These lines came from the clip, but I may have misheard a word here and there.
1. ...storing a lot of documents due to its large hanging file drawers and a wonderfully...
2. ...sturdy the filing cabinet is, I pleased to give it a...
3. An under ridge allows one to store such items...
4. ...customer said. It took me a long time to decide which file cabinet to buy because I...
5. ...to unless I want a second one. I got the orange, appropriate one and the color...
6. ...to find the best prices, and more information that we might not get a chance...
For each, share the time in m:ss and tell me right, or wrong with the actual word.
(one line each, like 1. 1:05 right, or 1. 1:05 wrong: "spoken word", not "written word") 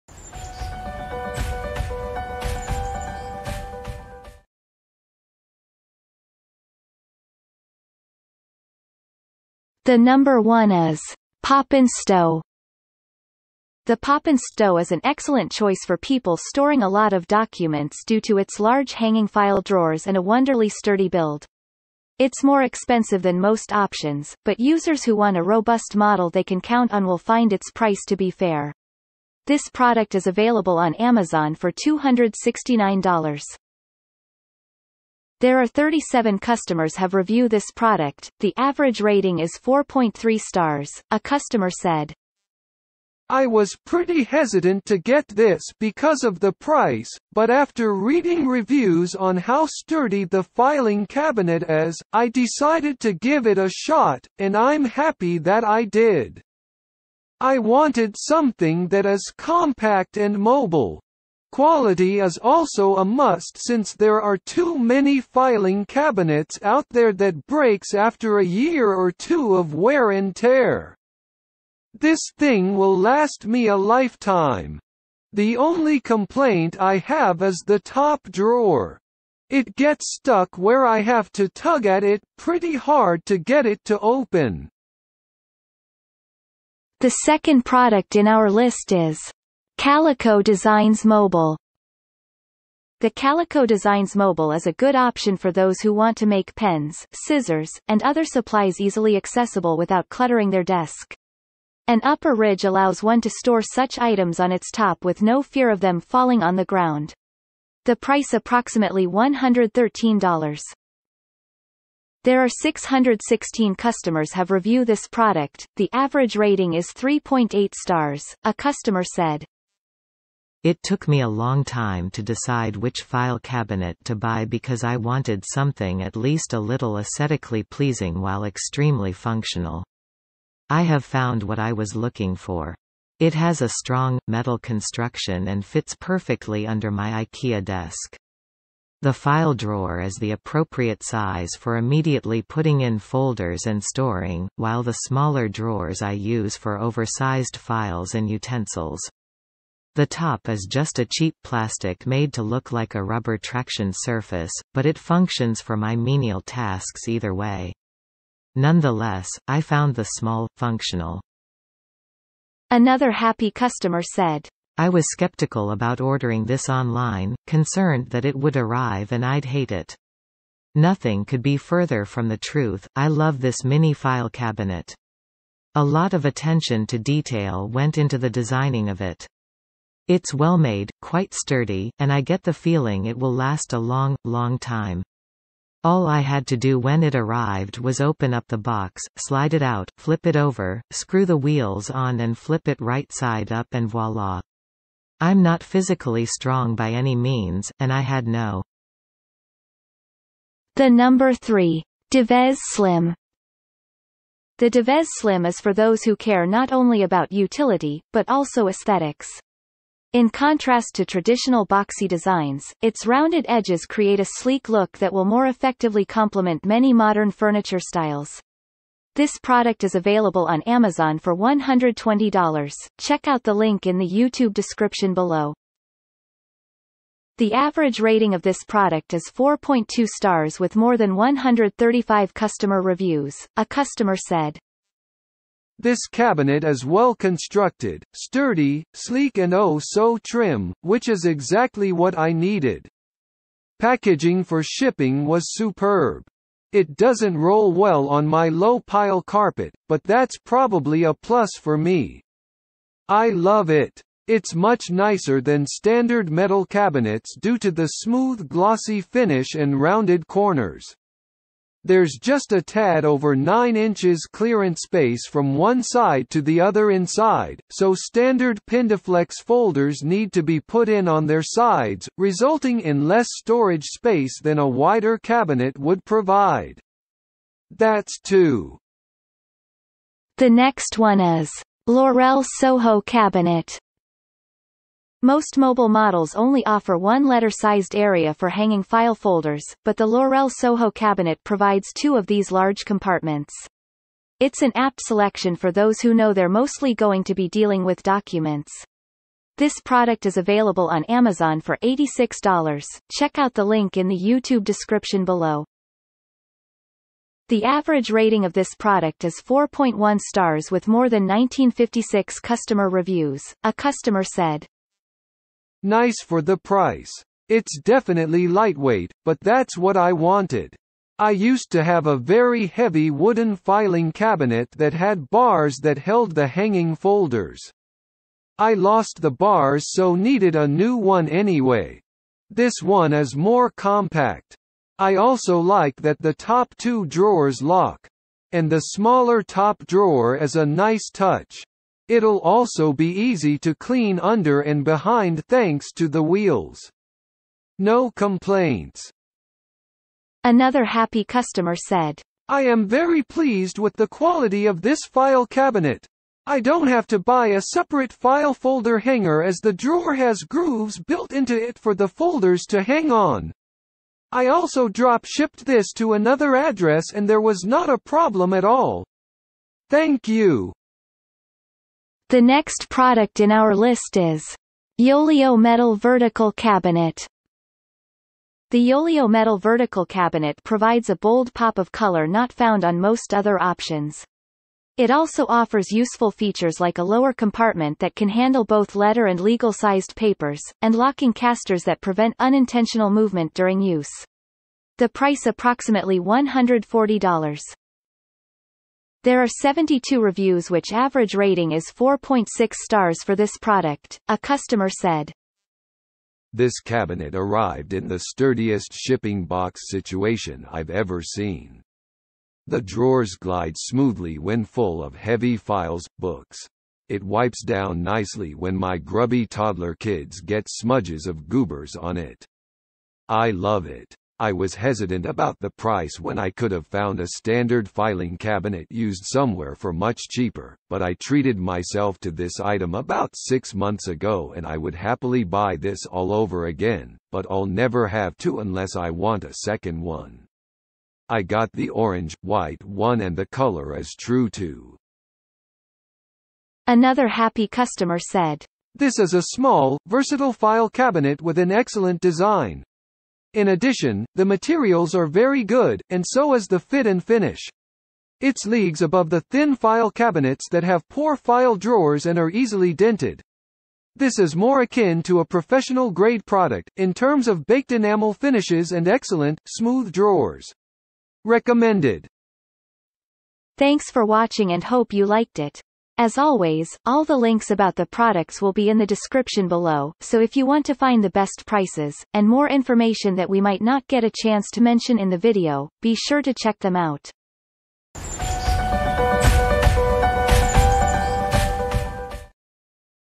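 1. 0:16 right
2. 0:49 wrong: "decided", not "pleased"
3. 1:41 wrong: "upper", not "under"
4. 1:58 right
5. 7:18 wrong: "white", not "appropriate"
6. 8:00 right.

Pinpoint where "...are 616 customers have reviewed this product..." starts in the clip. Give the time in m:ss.
1:52.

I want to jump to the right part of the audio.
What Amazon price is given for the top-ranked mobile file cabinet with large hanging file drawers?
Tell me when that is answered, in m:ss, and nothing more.
0:31.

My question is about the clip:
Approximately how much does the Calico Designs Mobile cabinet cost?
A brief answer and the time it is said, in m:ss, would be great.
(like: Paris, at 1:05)
$113, at 1:49.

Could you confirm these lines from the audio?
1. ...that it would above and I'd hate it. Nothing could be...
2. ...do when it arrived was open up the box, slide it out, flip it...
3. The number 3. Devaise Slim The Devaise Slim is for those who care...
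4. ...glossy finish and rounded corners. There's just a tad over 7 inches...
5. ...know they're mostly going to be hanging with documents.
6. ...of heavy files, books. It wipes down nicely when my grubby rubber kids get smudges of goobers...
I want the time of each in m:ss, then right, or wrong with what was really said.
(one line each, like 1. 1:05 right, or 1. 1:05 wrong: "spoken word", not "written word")
1. 2:48 wrong: "arrive", not "above"
2. 3:06 right
3. 3:20 right
4. 4:18 wrong: "9", not "7"
5. 4:56 wrong: "dealing", not "hanging"
6. 6:55 wrong: "toddler", not "rubber".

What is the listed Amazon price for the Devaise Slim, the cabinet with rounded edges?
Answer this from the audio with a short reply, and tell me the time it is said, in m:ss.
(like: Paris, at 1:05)
$120, at 3:41.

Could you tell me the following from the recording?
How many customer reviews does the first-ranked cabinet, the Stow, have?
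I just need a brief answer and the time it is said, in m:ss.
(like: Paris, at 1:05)
37, at 0:35.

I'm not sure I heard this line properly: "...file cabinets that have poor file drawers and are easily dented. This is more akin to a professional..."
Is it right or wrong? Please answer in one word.
right.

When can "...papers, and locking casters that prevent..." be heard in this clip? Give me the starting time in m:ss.
6:30.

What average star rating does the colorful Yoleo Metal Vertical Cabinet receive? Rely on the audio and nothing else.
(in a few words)
4.6 stars.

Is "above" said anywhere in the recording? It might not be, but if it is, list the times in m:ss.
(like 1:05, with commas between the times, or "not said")
7:39.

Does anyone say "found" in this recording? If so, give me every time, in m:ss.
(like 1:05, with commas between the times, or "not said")
2:11, 2:39, 6:22, 7:06.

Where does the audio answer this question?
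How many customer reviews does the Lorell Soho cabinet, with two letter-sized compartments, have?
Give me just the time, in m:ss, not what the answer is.
5:11.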